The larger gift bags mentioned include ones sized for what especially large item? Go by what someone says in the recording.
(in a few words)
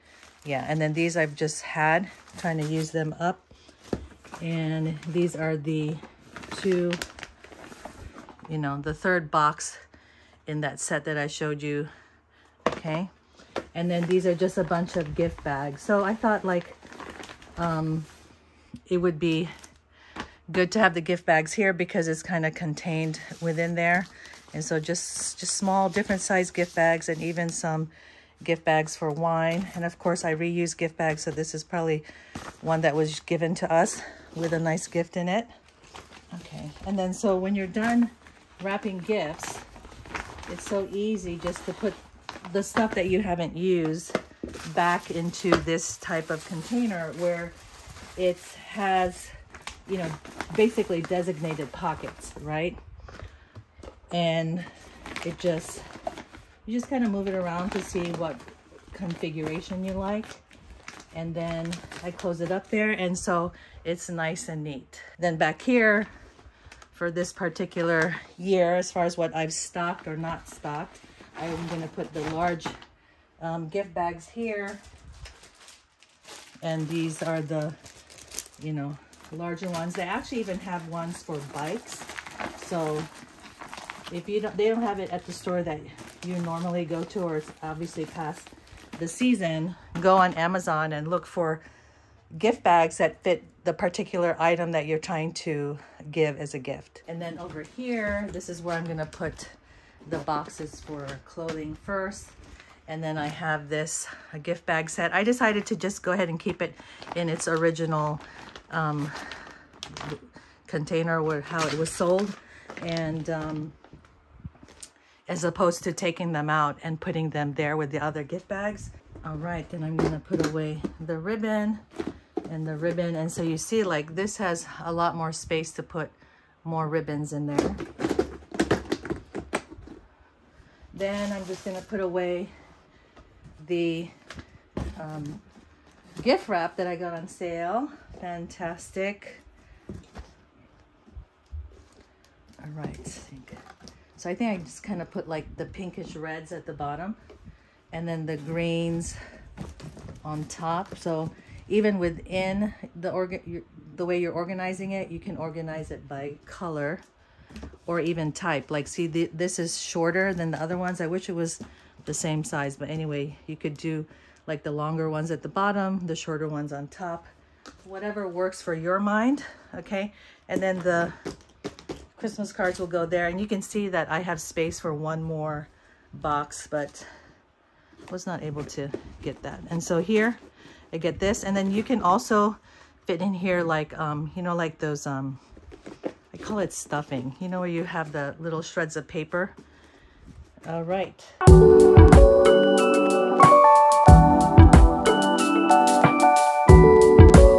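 Bikes.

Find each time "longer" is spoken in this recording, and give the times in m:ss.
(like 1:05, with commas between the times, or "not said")
2:44.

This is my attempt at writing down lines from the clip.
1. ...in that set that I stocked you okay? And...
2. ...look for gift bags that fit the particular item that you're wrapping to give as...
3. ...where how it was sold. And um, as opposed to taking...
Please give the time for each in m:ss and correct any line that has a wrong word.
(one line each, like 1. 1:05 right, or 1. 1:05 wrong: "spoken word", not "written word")
1. 0:10 wrong: "showed", not "stocked"
2. 1:31 wrong: "trying", not "wrapping"
3. 1:51 right.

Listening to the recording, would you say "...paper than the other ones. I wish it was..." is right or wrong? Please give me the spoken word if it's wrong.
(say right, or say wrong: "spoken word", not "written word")
wrong: "shorter", not "paper".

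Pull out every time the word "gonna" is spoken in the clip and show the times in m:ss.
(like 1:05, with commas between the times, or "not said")
1:38, 1:59, 2:11.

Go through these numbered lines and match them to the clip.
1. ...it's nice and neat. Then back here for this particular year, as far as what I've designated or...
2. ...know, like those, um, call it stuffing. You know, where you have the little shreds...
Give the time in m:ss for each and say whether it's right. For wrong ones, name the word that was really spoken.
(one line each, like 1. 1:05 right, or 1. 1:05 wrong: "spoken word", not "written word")
1. 1:03 wrong: "stocked", not "designated"
2. 3:04 right.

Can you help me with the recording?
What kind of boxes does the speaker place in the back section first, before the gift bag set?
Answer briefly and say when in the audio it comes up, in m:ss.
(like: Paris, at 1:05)
Boxes for clothing, at 1:40.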